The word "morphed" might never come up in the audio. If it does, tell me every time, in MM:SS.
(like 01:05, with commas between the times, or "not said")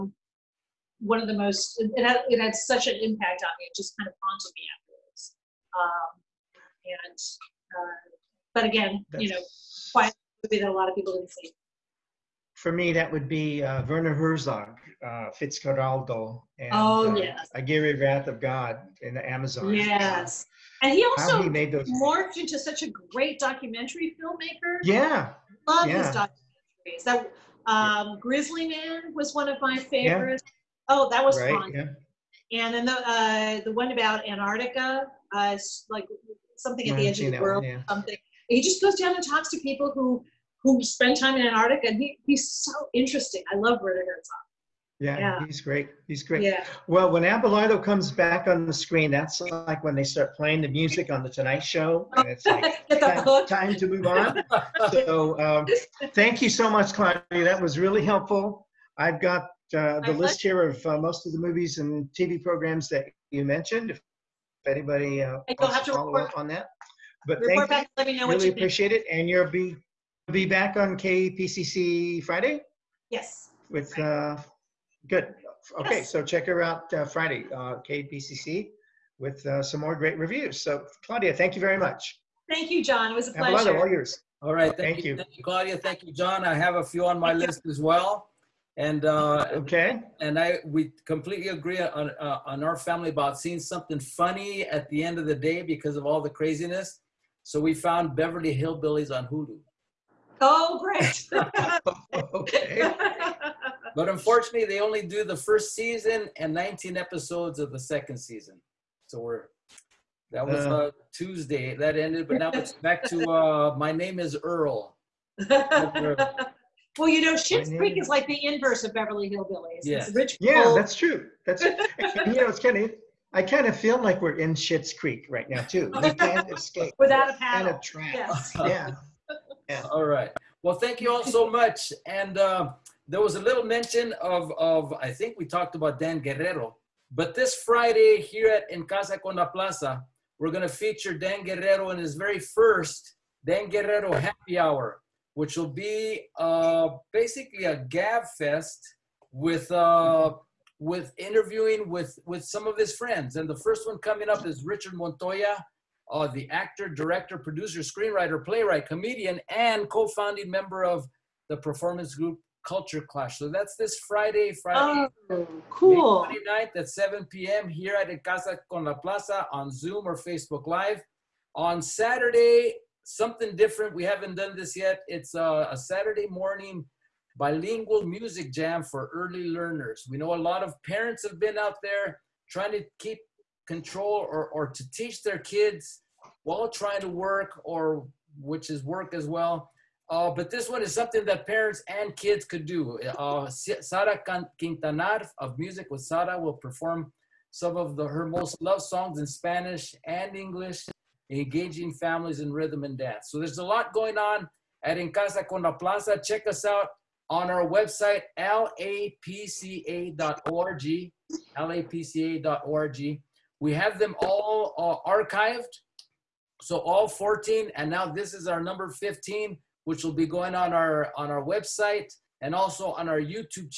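00:21.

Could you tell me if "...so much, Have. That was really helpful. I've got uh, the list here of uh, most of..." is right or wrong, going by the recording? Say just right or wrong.
wrong.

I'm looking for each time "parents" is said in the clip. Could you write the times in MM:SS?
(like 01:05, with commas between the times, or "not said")
03:00, 03:11.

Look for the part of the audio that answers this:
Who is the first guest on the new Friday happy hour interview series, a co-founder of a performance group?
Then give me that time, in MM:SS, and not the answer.
02:34.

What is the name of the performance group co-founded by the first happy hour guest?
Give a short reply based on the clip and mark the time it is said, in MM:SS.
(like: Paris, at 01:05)
Culture Clash, at 02:42.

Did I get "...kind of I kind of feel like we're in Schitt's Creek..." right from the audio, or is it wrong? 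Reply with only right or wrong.
right.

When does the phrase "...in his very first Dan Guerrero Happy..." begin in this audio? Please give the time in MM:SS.
02:21.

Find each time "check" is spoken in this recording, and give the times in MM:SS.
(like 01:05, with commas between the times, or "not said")
01:16, 03:26.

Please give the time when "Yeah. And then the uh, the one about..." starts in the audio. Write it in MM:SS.
00:31.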